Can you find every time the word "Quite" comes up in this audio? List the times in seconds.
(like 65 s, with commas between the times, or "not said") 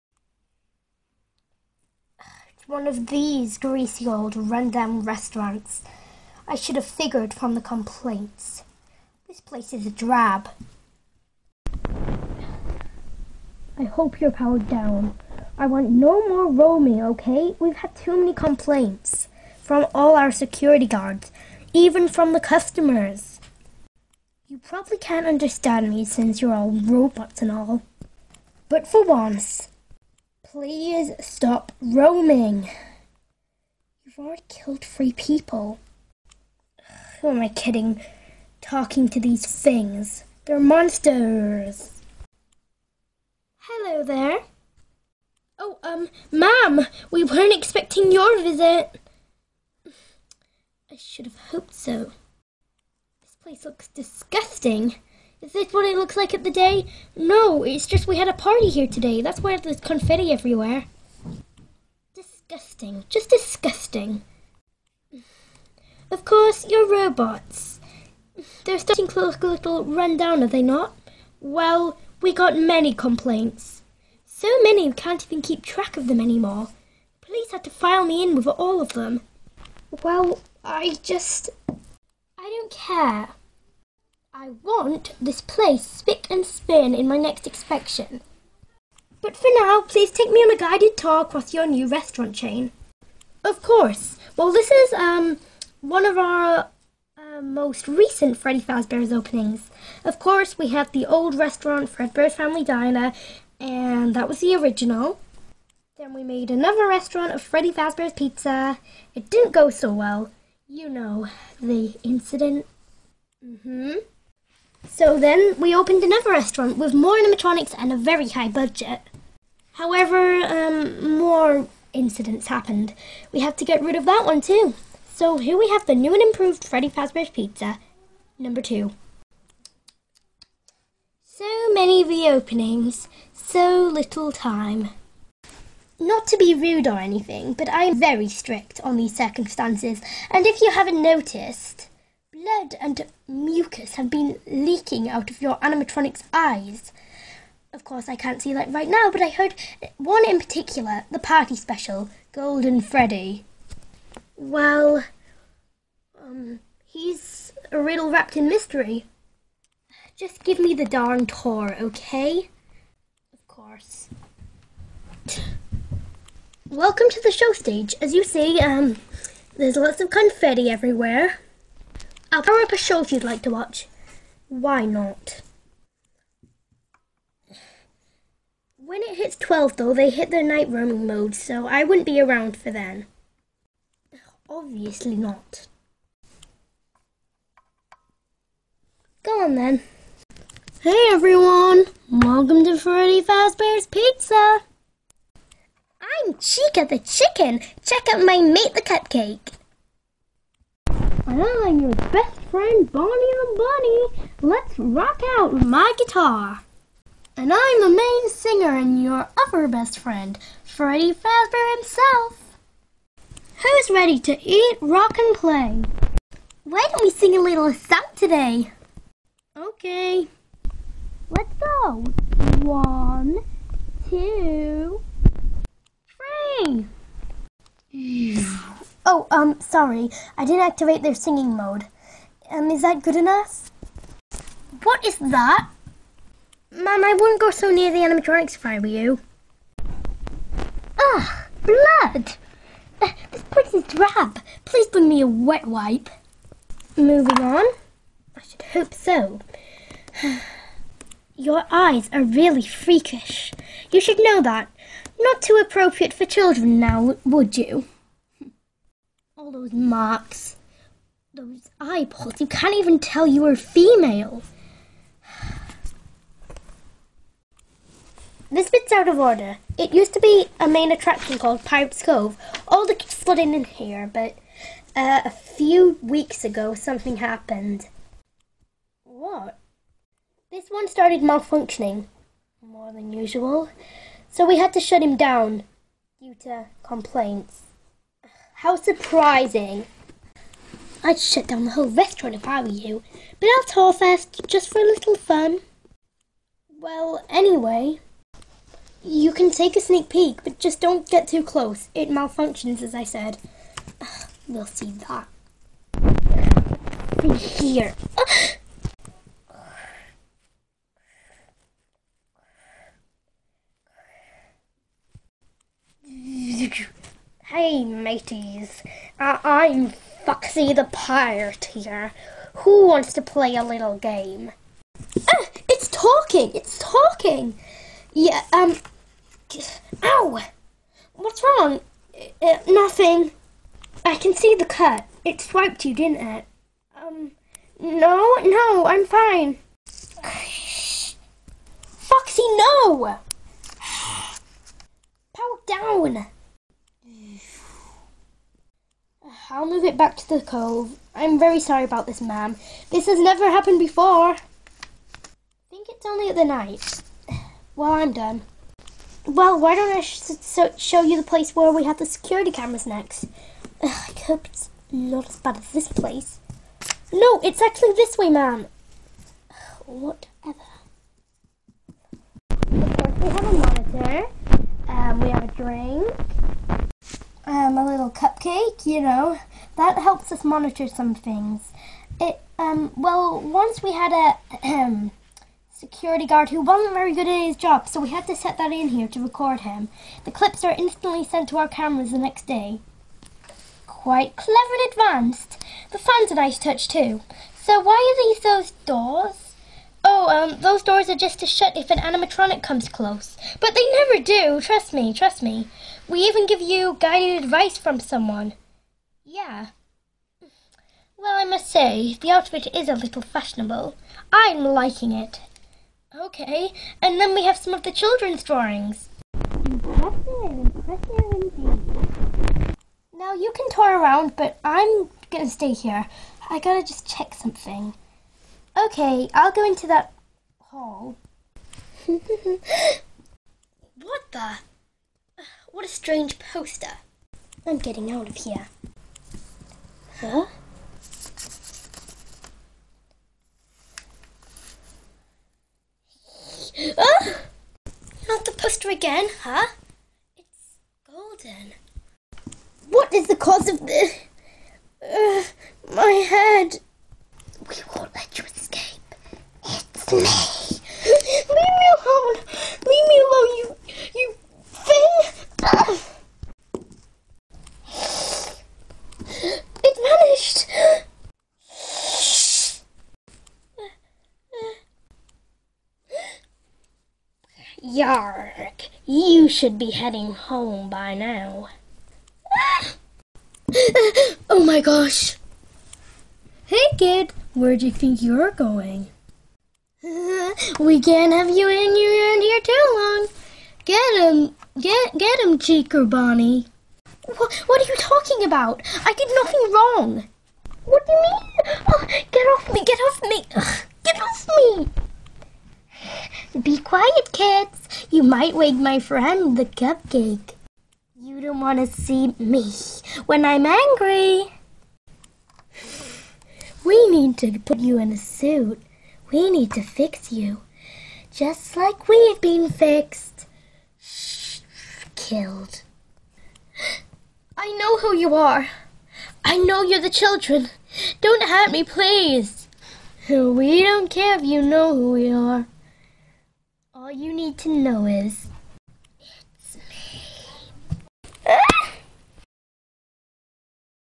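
393 s.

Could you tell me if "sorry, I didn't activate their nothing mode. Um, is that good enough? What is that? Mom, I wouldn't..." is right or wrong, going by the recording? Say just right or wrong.
wrong.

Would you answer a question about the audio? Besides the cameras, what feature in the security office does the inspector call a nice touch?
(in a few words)
The fan.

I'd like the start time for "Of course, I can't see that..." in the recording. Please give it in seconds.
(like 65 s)
147 s.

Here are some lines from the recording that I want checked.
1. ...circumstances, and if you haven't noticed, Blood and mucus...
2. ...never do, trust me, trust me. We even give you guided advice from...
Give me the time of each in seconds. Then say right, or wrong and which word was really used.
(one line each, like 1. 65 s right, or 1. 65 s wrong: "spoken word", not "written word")
1. 139 s right
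2. 403 s right.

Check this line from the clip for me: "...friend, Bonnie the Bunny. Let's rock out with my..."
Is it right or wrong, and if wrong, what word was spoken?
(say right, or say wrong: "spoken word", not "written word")
right.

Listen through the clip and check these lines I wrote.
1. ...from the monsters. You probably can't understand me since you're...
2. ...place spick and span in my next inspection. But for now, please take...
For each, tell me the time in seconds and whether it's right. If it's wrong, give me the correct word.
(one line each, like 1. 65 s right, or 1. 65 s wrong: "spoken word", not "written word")
1. 22 s wrong: "customers", not "monsters"
2. 85 s right.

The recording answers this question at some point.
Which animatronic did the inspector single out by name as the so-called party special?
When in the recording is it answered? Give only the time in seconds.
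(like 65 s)
152 s.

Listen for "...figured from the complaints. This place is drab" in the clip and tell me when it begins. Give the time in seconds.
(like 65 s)
6 s.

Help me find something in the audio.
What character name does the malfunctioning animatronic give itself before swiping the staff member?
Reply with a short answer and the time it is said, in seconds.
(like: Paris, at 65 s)
Foxy the Pirate, at 320 s.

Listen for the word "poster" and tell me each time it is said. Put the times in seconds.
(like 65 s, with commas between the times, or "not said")
436 s, 448 s.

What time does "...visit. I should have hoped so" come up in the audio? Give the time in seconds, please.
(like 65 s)
48 s.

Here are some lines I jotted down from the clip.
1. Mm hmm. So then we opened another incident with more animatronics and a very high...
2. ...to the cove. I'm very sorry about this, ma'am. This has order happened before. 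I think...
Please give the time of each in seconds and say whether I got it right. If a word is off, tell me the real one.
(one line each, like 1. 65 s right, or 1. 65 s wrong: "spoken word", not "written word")
1. 113 s wrong: "restaurant", not "incident"
2. 350 s wrong: "never", not "order".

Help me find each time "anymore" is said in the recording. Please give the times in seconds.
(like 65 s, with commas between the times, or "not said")
76 s.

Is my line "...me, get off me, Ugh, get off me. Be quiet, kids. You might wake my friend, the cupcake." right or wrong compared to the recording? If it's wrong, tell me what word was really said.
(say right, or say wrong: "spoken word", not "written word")
right.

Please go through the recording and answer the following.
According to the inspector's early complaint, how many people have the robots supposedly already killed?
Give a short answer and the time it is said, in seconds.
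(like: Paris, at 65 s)
3, at 34 s.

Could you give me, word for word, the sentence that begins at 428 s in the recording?
Okay, I'll go into that hall.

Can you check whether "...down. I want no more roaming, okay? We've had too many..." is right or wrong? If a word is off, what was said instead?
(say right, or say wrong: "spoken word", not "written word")
right.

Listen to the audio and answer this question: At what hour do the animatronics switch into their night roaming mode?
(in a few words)
12.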